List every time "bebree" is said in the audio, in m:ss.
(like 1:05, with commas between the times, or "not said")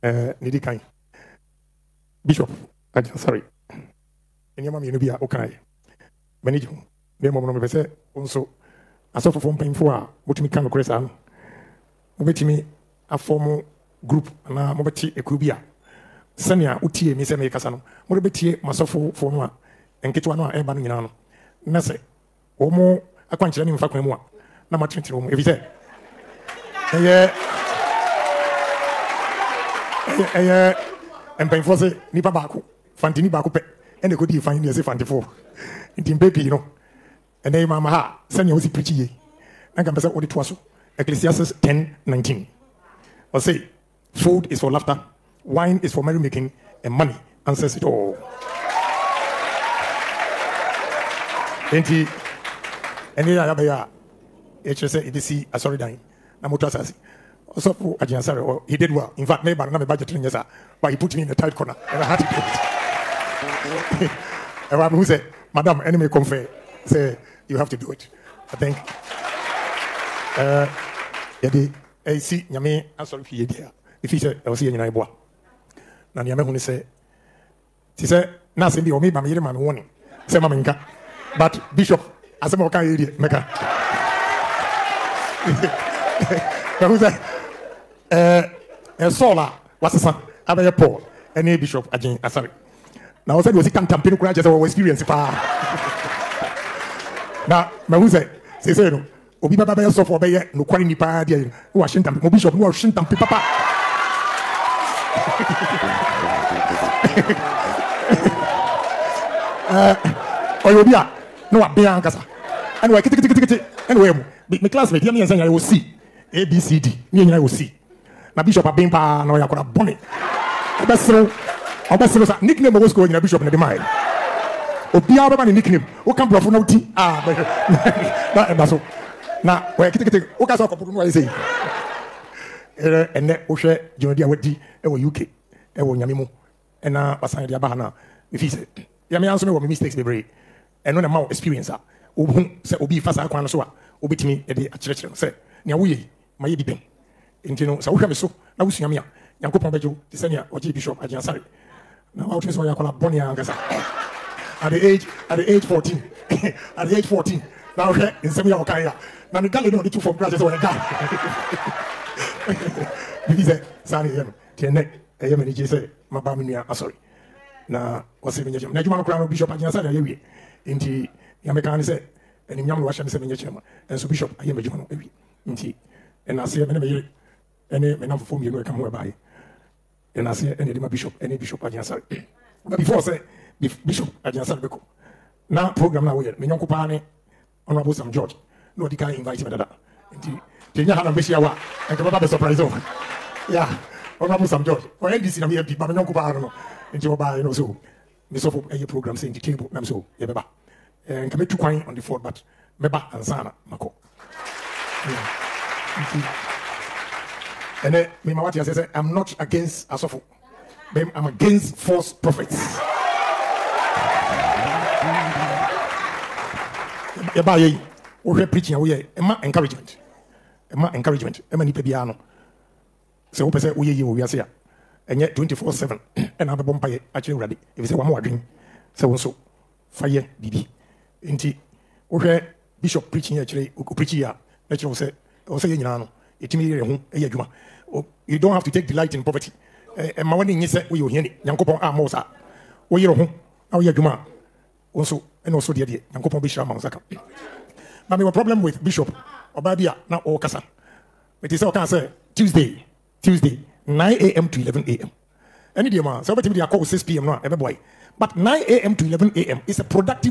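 2:19.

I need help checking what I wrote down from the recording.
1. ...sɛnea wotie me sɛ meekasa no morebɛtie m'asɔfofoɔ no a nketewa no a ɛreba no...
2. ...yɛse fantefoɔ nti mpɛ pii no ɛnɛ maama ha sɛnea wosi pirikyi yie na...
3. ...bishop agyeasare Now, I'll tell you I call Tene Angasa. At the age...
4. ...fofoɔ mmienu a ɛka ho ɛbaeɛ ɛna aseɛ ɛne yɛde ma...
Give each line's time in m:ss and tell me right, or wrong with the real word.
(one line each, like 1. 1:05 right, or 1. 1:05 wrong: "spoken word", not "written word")
1. 0:16 right
2. 0:34 right
3. 2:30 wrong: "Bonnie", not "Tene"
4. 2:58 right.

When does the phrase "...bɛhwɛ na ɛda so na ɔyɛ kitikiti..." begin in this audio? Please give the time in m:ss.
2:07.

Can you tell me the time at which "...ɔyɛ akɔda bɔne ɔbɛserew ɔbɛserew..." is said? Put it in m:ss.
1:59.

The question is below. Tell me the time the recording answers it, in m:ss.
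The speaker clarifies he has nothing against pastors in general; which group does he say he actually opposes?
3:31.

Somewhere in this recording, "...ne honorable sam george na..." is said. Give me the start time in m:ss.
3:06.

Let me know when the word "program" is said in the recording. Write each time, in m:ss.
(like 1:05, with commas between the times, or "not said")
3:05, 3:18.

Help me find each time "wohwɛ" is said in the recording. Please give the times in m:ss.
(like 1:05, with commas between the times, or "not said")
2:13, 2:27, 3:38, 3:52.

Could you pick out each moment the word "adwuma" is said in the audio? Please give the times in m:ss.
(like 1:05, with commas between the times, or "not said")
2:48, 2:54, 3:57, 4:03.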